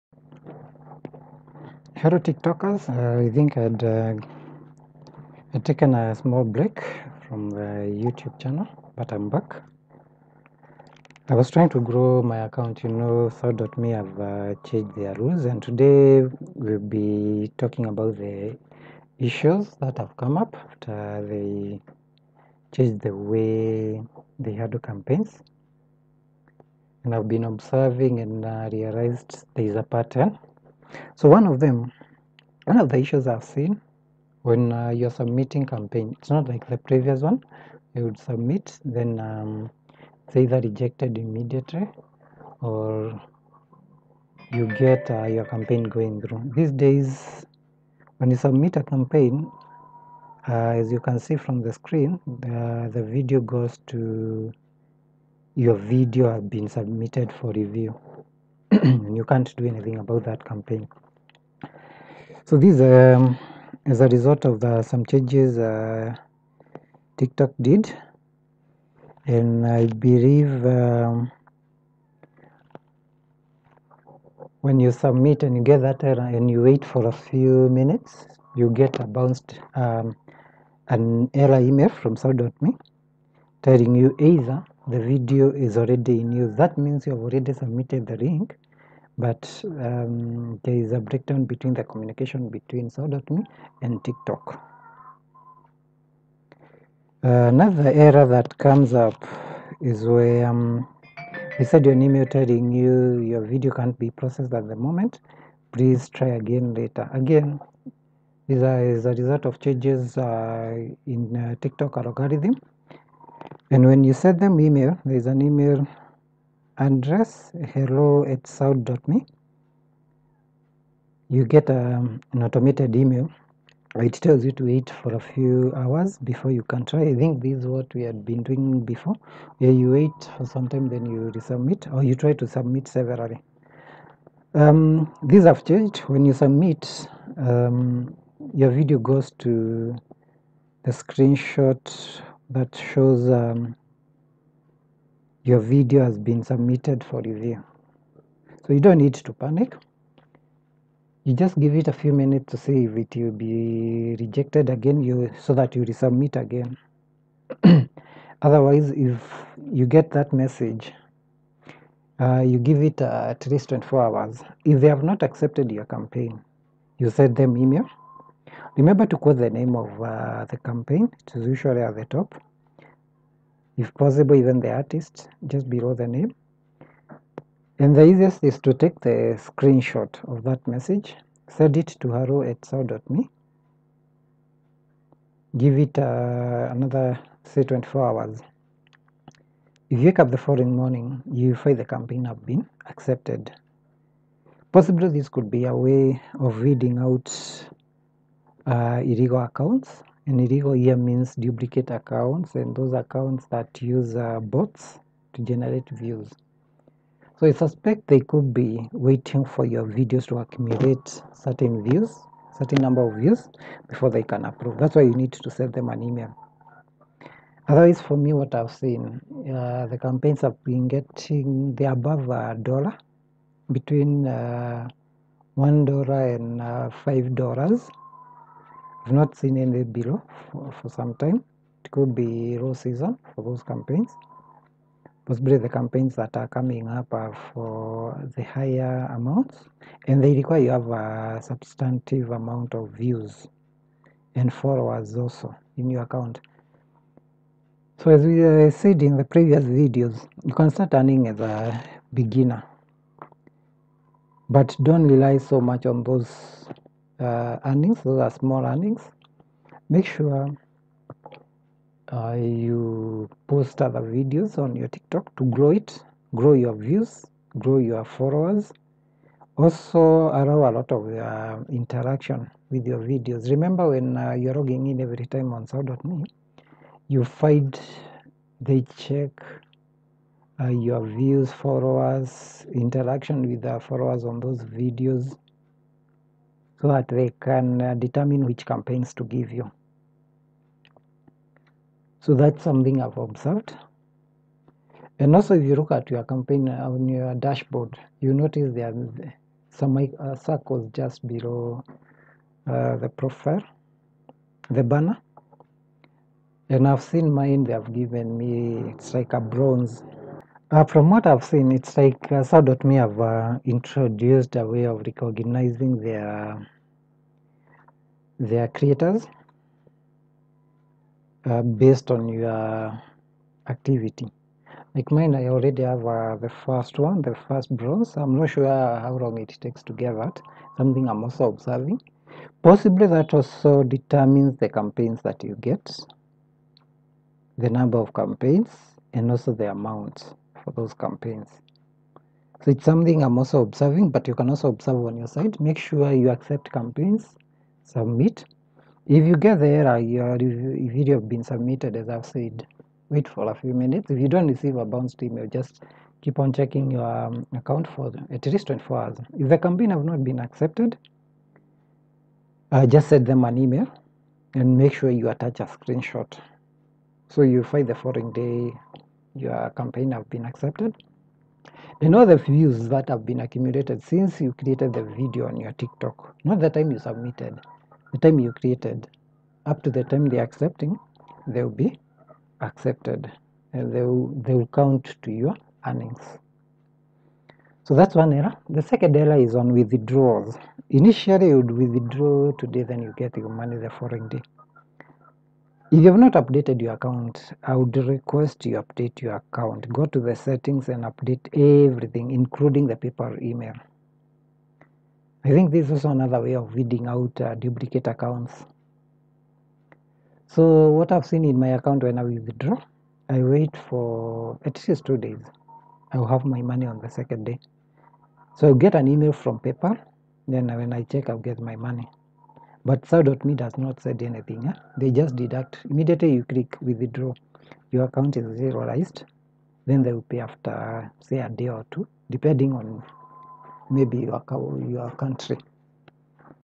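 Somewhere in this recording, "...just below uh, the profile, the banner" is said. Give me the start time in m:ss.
5:00.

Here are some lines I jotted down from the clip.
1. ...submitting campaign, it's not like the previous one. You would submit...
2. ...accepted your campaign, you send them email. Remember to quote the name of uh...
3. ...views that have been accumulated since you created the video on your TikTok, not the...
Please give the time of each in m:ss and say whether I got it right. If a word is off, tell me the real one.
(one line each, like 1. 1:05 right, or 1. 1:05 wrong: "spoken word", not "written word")
1. 0:35 right
2. 2:45 right
3. 6:12 right.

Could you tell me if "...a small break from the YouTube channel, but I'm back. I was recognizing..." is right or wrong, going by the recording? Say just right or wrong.
wrong.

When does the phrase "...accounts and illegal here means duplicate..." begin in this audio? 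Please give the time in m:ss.
3:19.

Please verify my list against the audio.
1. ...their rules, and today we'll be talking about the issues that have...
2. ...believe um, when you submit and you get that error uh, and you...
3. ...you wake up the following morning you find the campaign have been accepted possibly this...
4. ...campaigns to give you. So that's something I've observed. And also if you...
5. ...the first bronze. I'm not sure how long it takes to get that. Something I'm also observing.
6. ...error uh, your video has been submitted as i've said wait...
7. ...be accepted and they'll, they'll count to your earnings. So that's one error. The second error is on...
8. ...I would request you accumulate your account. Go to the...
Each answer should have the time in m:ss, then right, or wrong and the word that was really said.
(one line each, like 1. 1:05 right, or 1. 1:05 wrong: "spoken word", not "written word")
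1. 0:14 right
2. 1:10 right
3. 3:09 right
4. 4:48 right
5. 5:27 right
6. 5:49 right
7. 6:21 right
8. 6:37 wrong: "update", not "accumulate".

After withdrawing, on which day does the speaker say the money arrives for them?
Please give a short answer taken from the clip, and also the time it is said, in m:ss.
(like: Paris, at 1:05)
the second day, at 6:57.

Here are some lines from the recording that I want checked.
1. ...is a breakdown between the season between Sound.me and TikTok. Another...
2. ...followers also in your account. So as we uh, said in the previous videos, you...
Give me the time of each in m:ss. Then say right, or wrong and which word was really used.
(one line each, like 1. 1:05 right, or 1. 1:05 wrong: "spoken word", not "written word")
1. 1:30 wrong: "communication", not "season"
2. 4:04 right.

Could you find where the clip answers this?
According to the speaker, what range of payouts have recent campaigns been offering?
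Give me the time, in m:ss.
3:43.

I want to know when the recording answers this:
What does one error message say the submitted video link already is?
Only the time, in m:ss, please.
1:26.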